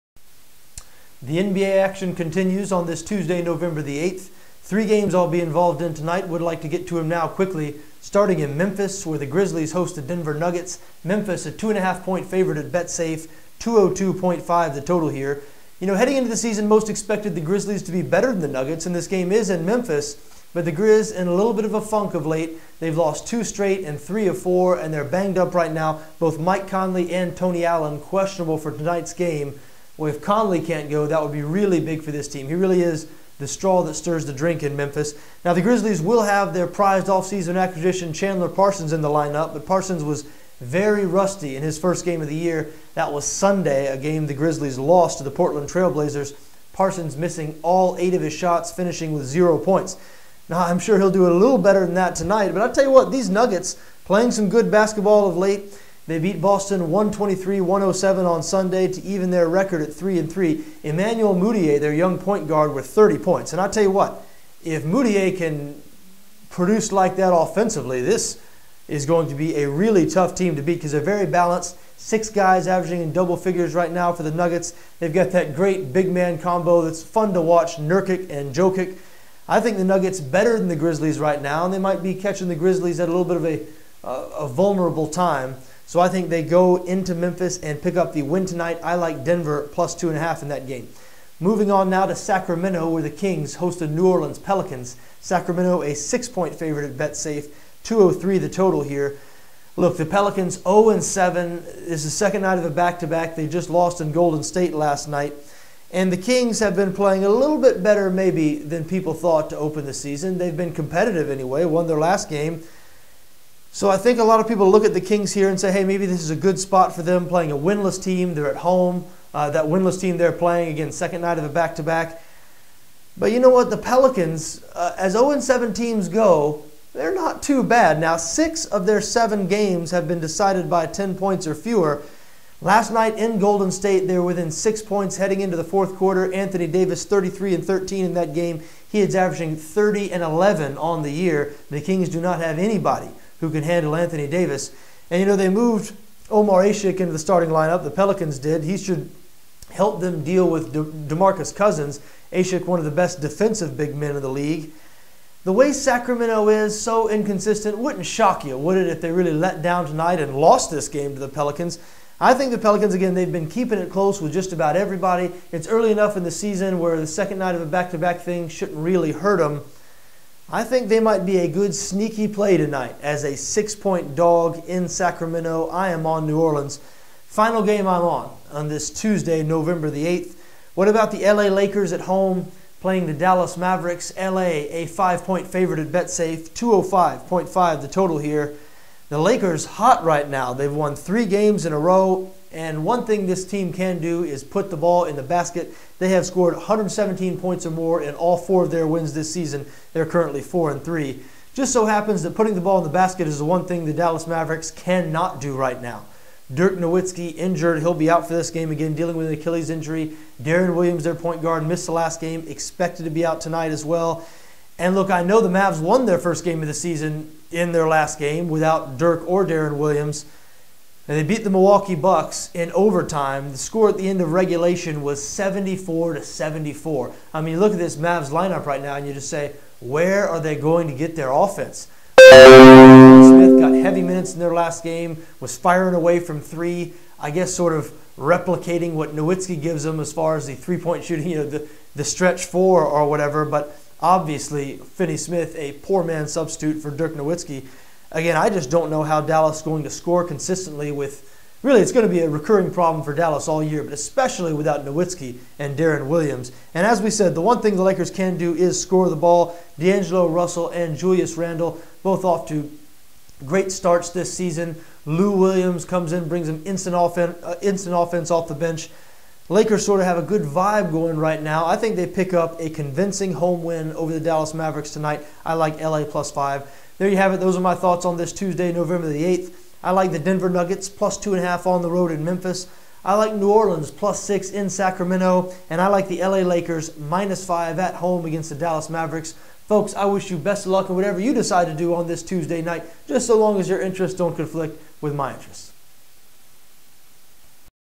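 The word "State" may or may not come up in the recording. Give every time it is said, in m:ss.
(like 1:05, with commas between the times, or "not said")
1:44, 2:13.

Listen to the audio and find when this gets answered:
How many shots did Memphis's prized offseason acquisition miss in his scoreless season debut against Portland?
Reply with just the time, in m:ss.
0:47.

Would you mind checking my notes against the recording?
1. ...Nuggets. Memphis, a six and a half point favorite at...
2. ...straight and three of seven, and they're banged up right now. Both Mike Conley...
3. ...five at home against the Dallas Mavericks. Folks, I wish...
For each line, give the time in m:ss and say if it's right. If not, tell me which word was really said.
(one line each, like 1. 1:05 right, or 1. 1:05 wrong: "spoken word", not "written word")
1. 0:10 wrong: "two", not "six"
2. 0:23 wrong: "four", not "seven"
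3. 4:47 right.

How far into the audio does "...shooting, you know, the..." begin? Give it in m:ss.
4:01.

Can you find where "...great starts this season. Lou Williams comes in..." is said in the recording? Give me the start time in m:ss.
4:23.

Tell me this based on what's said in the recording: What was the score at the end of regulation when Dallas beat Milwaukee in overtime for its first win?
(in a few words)
74-74.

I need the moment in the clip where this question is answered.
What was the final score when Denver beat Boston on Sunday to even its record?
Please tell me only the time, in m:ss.
0:56.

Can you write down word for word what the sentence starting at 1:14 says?
They've got that great big man combo that's fun to watch, Nurkic and Jokic.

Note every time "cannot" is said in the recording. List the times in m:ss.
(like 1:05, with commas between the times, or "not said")
3:24.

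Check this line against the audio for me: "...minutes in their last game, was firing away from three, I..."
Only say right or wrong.
right.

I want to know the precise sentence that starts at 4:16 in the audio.
And as we said, the one thing the Lakers can do is score the ball.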